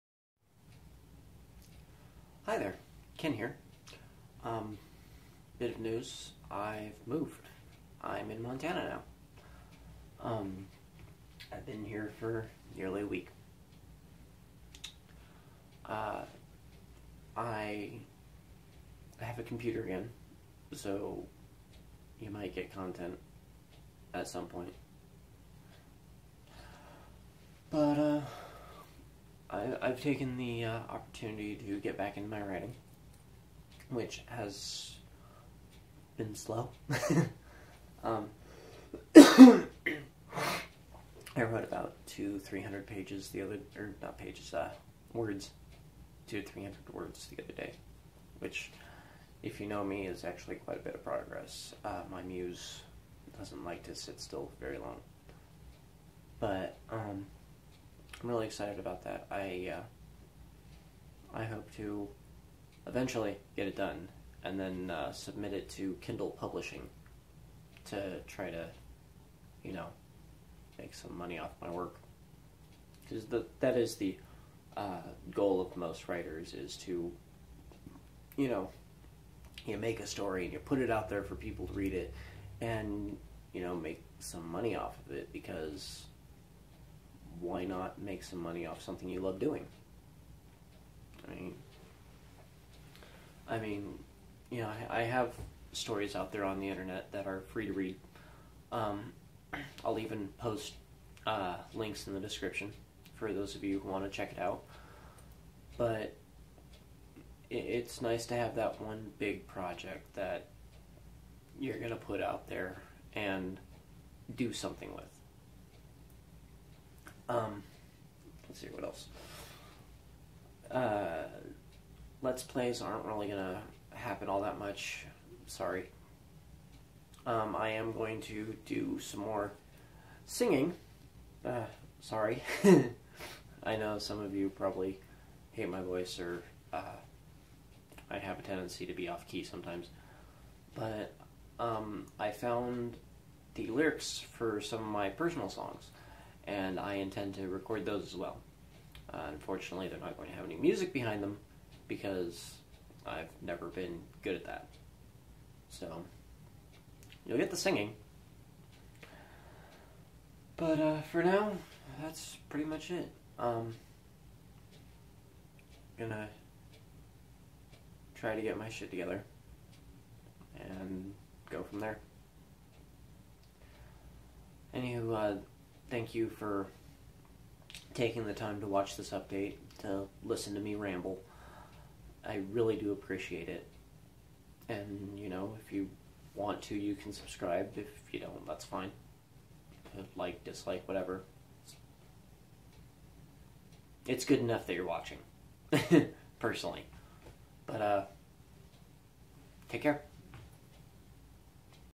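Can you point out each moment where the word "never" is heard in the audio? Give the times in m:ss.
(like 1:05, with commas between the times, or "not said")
2:33.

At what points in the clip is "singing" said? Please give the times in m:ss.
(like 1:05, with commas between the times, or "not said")
2:10, 2:37.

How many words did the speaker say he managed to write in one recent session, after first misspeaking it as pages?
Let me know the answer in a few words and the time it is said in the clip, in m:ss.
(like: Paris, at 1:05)
200-300, at 0:46.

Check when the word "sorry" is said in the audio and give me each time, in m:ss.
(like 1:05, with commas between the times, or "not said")
2:05, 2:11.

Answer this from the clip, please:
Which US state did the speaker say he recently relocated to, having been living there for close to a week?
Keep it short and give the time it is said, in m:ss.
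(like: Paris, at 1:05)
Montana, at 0:08.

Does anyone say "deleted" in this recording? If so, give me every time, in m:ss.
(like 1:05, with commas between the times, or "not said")
not said.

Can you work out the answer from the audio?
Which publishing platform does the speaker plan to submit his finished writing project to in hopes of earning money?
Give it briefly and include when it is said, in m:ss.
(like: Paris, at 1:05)
Kindle Publishing, at 1:06.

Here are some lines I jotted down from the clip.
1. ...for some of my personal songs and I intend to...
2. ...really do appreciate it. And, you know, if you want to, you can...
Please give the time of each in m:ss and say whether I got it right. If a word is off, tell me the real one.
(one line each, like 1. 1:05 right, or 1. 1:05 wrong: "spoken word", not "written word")
1. 2:24 right
2. 3:02 right.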